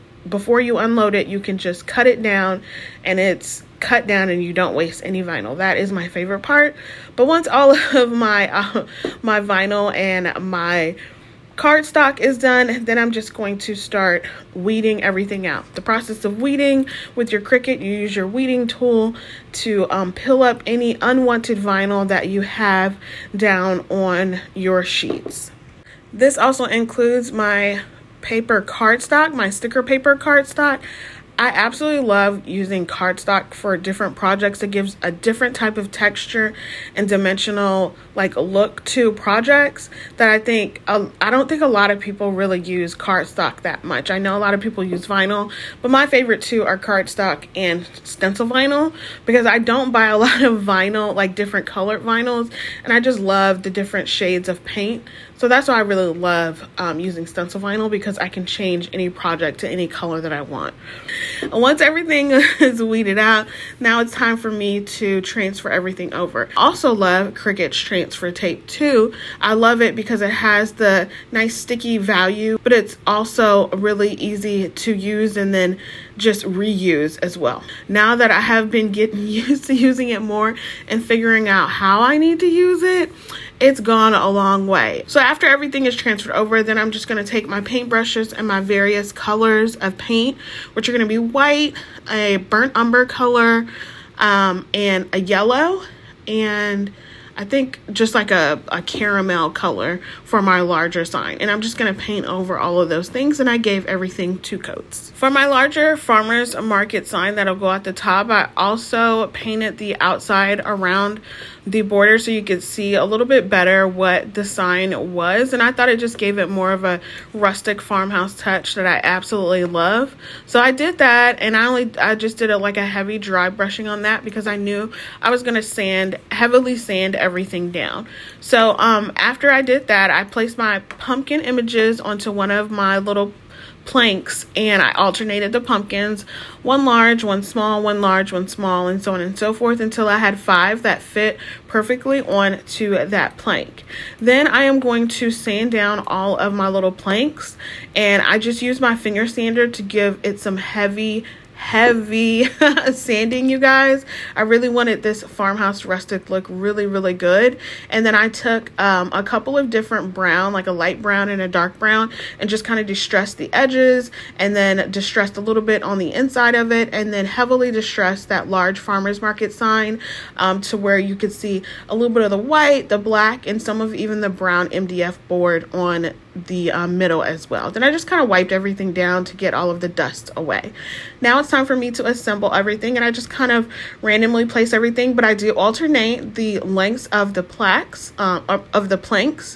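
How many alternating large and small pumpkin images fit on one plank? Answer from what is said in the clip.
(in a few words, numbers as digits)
5.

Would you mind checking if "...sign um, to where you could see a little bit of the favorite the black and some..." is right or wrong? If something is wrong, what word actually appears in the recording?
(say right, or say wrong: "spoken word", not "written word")
wrong: "white", not "favorite".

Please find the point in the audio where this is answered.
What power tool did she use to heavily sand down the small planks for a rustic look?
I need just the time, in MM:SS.
02:28.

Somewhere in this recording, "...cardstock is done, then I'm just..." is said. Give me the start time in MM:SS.
00:11.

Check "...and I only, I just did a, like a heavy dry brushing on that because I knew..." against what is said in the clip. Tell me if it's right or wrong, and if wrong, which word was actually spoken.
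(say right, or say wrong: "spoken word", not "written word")
right.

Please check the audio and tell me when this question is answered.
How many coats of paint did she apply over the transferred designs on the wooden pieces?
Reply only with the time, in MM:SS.
01:44.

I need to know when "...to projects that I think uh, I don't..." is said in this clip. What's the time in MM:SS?
00:38.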